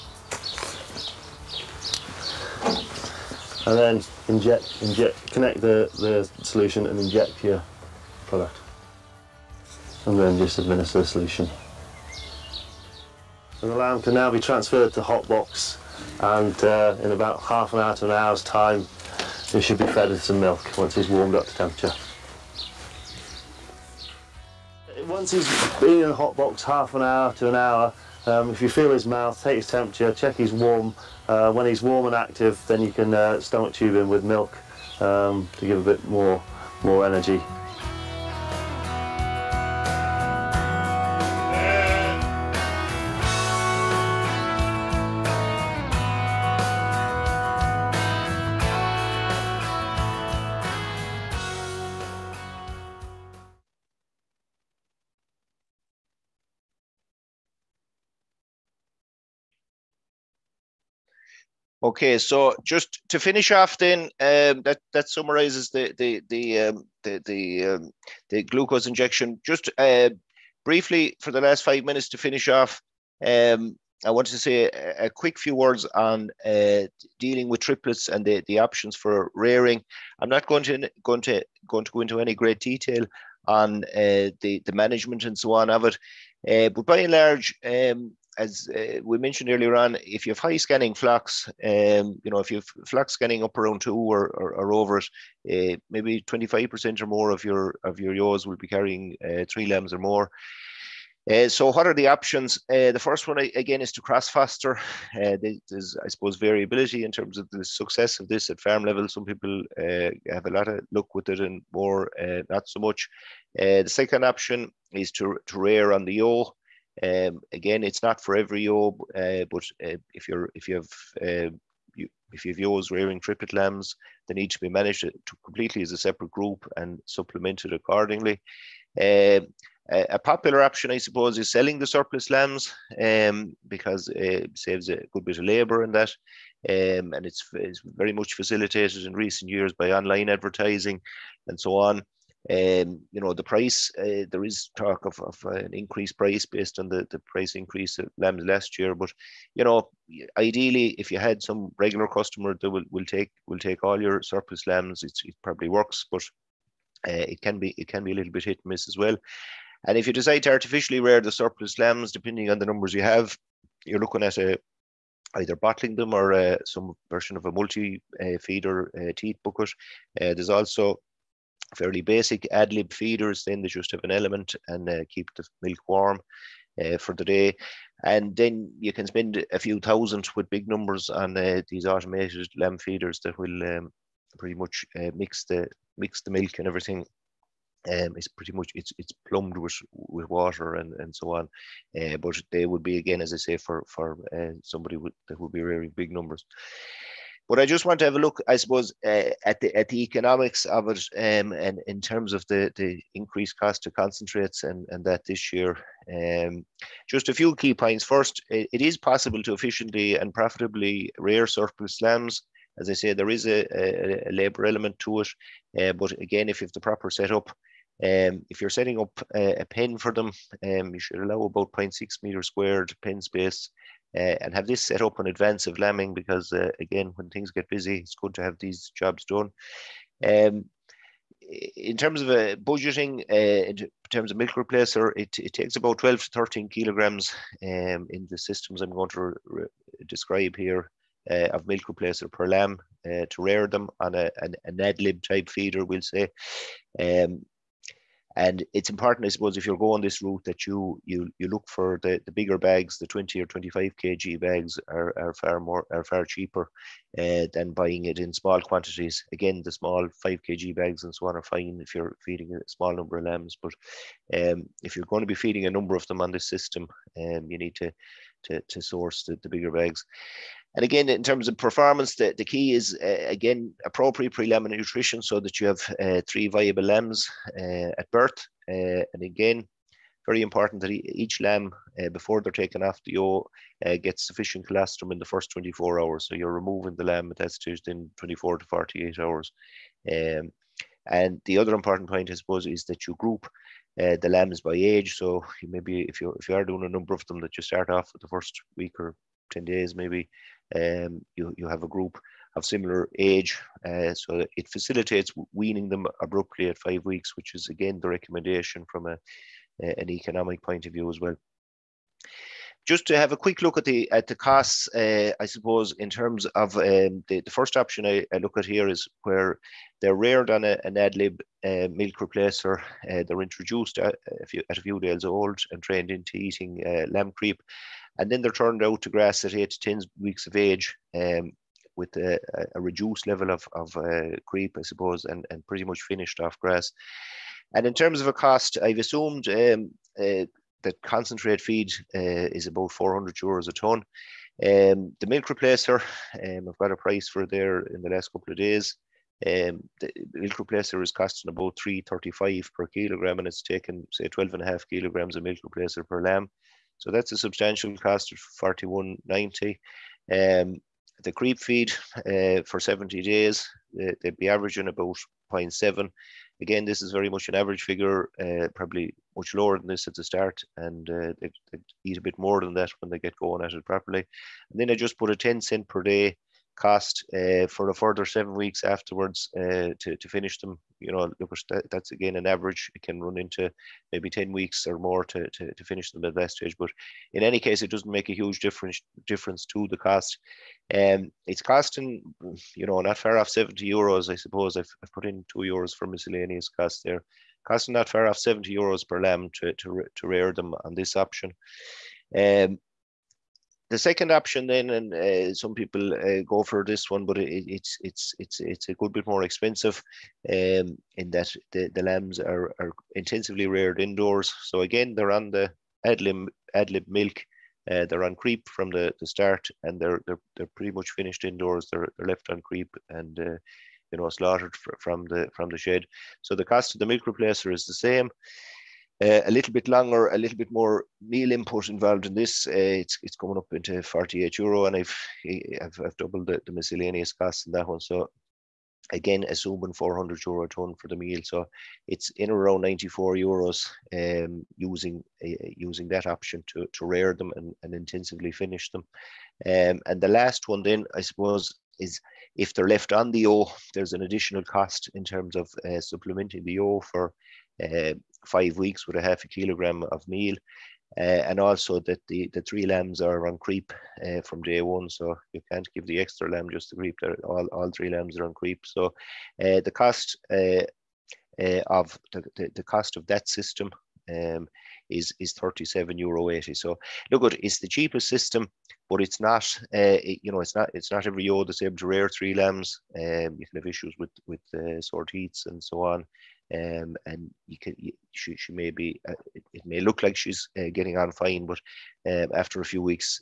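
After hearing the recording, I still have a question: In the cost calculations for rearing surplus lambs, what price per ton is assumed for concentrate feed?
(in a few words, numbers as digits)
400 euros.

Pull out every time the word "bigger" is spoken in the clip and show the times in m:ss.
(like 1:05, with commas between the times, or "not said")
4:12, 4:29.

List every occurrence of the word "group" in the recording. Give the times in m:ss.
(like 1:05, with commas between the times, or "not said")
2:06, 4:53, 5:01.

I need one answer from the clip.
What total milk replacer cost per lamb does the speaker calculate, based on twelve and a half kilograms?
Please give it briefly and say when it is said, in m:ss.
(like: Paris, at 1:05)
41.90, at 5:58.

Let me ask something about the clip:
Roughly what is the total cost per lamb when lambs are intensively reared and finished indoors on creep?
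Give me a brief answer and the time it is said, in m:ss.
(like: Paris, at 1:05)
94 euros, at 7:22.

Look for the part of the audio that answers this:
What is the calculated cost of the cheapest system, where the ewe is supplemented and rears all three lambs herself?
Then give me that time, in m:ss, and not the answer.
7:55.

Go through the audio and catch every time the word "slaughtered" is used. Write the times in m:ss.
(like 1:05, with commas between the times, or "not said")
7:04.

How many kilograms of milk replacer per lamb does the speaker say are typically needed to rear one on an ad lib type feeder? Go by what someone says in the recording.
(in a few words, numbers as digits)
12 to 13 kg.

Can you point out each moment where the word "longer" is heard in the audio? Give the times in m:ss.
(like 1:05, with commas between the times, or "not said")
7:09.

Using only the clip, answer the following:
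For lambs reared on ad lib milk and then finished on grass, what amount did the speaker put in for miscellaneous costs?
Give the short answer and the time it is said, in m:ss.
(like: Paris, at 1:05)
2 euros, at 6:35.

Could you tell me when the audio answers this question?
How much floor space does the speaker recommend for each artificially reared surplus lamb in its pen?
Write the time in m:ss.
3:41.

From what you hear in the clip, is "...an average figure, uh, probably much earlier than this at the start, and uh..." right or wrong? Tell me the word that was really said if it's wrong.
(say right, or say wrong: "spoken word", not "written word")
wrong: "lower", not "earlier".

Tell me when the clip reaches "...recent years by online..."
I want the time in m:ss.
2:19.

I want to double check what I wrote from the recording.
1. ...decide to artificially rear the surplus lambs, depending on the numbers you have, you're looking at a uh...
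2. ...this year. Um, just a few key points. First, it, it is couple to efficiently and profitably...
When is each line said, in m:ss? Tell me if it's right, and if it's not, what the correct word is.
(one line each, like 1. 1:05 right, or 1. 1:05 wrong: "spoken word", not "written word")
1. 2:40 right
2. 3:25 wrong: "possible", not "couple".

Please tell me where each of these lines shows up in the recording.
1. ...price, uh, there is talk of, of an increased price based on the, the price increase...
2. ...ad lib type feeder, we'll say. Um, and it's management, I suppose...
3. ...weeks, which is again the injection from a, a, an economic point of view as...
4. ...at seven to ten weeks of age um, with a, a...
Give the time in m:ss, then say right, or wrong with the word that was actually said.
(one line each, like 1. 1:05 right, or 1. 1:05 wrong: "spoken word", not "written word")
1. 2:23 right
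2. 4:04 wrong: "important", not "management"
3. 5:07 wrong: "recommendation", not "injection"
4. 5:29 wrong: "eight", not "seven".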